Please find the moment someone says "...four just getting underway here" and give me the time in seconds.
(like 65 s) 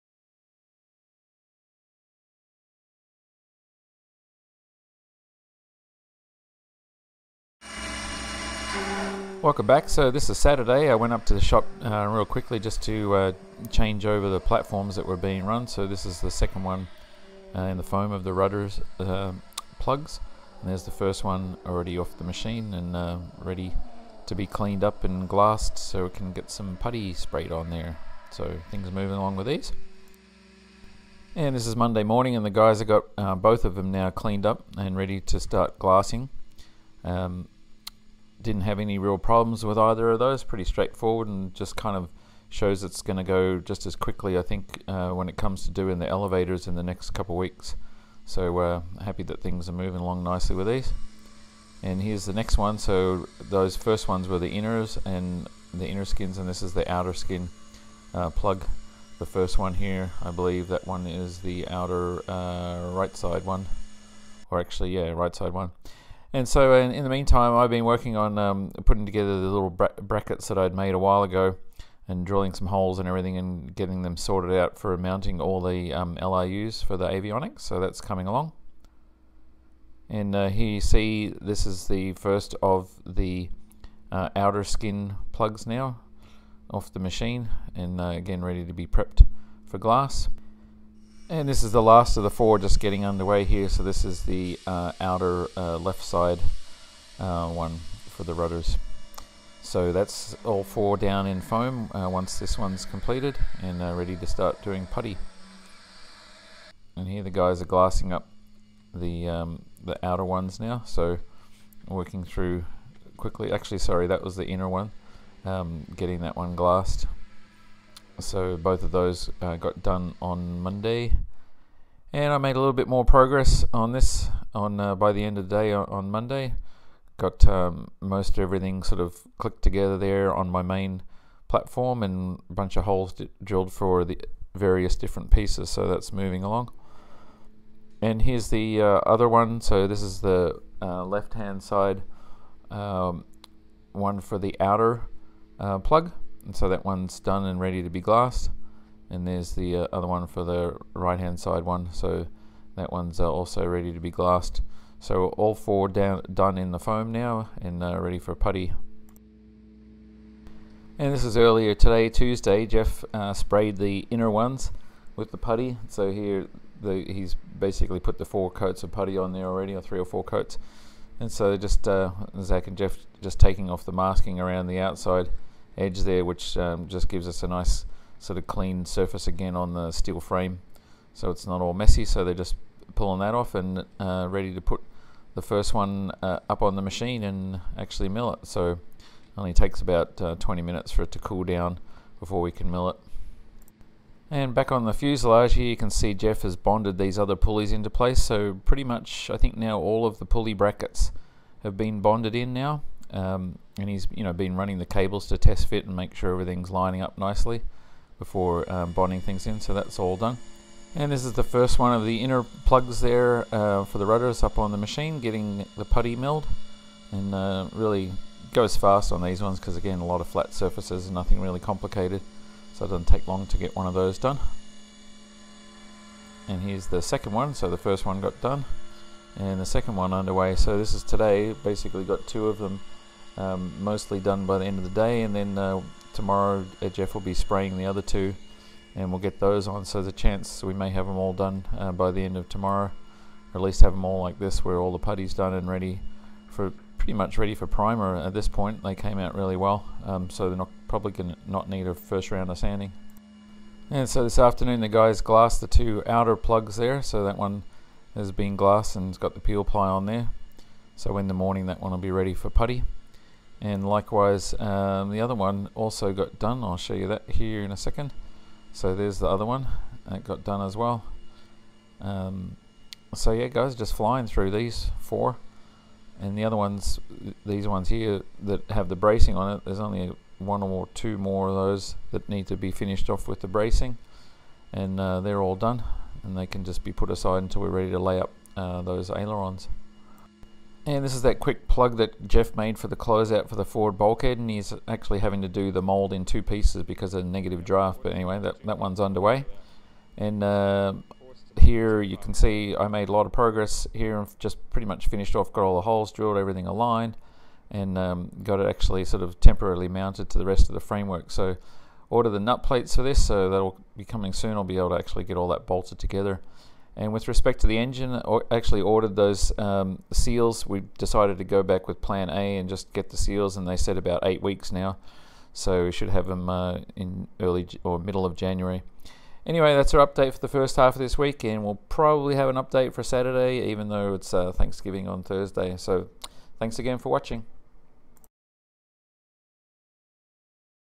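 92 s.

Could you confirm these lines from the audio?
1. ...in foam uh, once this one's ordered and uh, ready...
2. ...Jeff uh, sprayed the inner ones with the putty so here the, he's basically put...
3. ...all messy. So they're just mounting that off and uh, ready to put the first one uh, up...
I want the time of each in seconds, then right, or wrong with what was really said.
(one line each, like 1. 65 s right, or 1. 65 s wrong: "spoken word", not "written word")
1. 101 s wrong: "completed", not "ordered"
2. 162 s right
3. 181 s wrong: "pulling", not "mounting".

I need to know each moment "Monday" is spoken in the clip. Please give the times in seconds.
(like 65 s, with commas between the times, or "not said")
31 s, 120 s, 126 s.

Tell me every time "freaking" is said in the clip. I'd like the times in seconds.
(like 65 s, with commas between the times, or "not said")
not said.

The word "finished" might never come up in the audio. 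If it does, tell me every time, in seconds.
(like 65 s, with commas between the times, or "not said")
282 s, 305 s.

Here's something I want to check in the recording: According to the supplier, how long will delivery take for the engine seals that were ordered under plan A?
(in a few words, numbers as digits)
About 8 weeks.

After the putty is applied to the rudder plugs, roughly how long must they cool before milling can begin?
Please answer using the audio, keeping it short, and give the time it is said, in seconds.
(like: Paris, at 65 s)
20 minutes, at 190 s.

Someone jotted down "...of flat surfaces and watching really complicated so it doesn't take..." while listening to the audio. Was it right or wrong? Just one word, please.
wrong.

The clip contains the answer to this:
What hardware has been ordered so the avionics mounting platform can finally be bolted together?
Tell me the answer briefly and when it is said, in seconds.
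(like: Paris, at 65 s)
Nut plates, at 312 s.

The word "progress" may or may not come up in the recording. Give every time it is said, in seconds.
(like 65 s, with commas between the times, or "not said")
123 s, 303 s.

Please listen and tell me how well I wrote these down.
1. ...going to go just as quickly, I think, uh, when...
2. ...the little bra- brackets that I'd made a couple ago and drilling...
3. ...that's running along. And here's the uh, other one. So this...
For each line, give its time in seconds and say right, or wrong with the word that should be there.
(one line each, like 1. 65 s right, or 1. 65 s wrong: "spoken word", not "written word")
1. 43 s right
2. 69 s wrong: "while", not "couple"
3. 135 s wrong: "moving", not "running".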